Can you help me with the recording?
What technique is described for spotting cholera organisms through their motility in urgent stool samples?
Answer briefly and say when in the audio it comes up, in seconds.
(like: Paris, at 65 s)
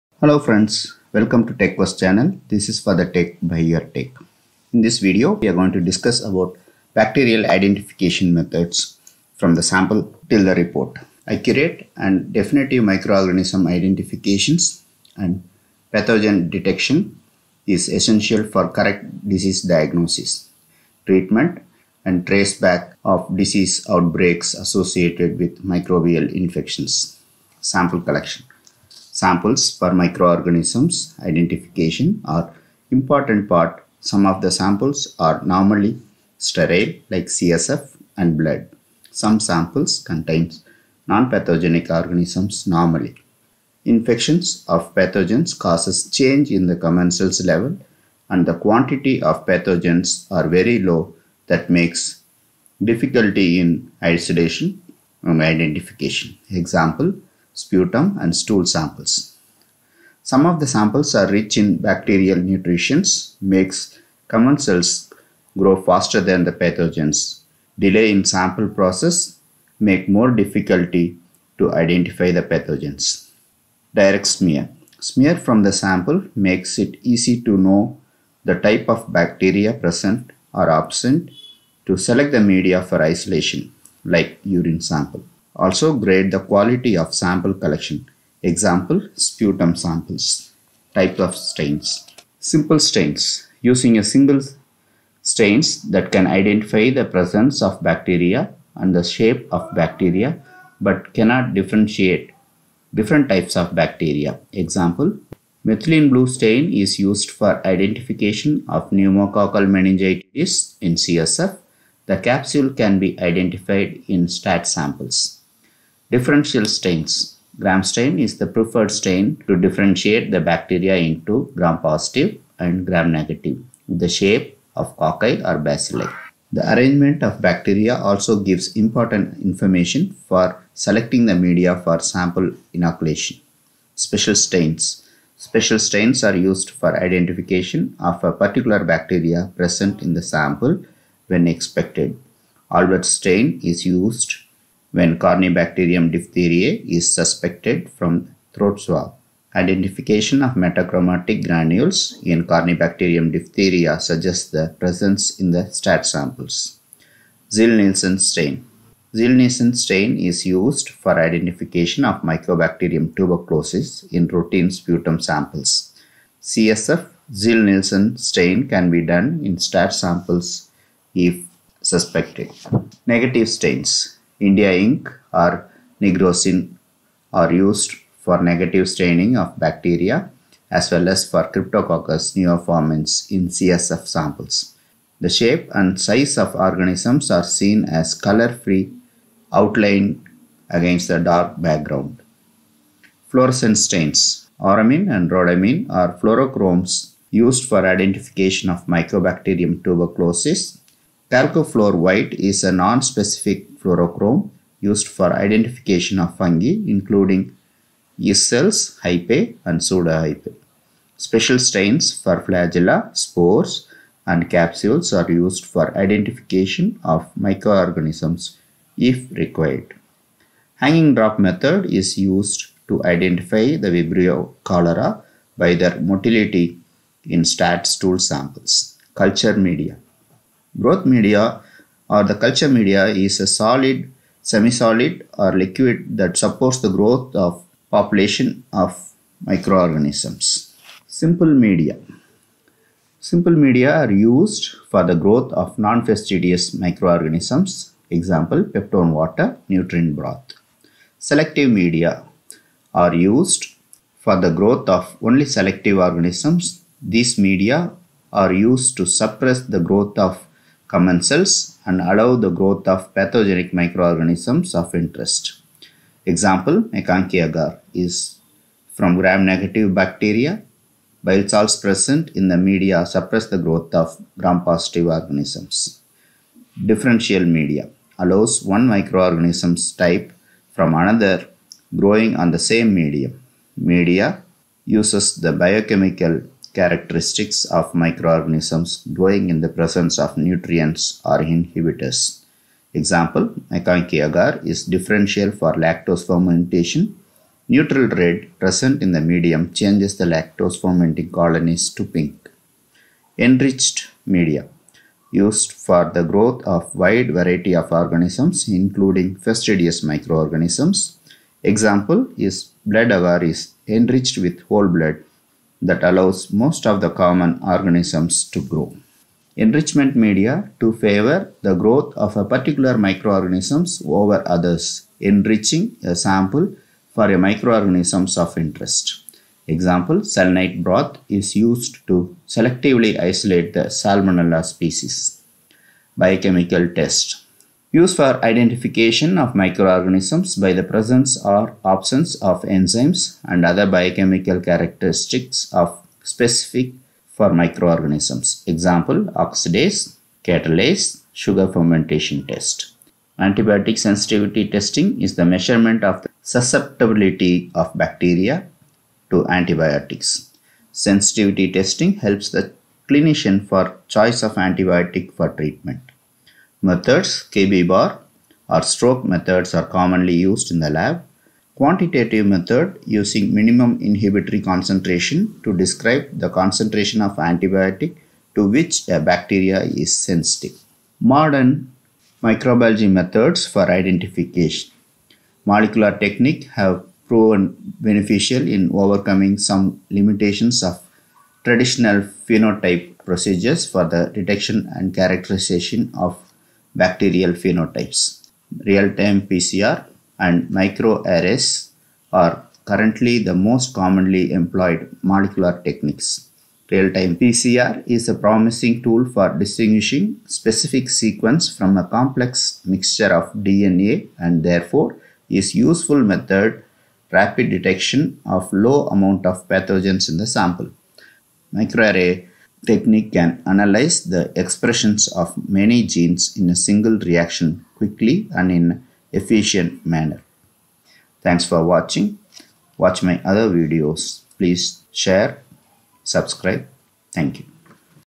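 Hanging drop method, at 220 s.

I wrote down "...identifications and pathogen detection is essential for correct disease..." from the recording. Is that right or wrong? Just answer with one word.
right.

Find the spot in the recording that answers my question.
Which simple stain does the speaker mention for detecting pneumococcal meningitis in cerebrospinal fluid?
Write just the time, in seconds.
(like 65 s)
105 s.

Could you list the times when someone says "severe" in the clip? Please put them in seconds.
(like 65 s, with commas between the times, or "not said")
not said.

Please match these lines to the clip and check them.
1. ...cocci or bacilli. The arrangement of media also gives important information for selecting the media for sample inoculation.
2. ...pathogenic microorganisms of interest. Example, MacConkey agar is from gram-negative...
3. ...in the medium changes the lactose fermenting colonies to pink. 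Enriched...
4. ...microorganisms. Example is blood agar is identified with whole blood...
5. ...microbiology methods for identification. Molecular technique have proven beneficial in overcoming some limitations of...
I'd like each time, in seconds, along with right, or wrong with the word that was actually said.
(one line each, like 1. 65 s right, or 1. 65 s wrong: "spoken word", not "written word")
1. 124 s wrong: "bacteria", not "media"
2. 263 s right
3. 299 s right
4. 310 s wrong: "enriched", not "identified"
5. 382 s right.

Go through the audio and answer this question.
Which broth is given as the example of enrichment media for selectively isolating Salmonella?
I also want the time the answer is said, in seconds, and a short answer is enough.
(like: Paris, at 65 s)
Selenite broth, at 330 s.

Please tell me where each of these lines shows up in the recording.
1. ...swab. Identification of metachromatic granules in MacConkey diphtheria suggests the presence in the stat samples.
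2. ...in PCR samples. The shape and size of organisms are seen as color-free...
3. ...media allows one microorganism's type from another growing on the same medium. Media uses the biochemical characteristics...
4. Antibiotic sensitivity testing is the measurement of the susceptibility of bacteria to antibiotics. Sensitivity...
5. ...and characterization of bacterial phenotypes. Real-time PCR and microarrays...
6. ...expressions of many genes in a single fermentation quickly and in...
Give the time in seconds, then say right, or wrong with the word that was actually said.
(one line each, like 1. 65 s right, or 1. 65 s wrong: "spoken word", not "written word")
1. 148 s wrong: "Corynebacterium", not "MacConkey"
2. 183 s wrong: "CSF", not "PCR"
3. 277 s right
4. 353 s right
5. 394 s right
6. 424 s wrong: "reaction", not "fermentation".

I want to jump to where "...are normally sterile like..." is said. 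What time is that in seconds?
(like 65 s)
35 s.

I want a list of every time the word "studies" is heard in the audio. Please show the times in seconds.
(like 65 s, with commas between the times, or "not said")
not said.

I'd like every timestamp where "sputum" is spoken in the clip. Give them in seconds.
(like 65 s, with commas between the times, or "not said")
57 s, 89 s, 164 s.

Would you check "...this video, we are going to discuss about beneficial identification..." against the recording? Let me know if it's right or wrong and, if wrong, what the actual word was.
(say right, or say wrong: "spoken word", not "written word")
wrong: "bacterial", not "beneficial".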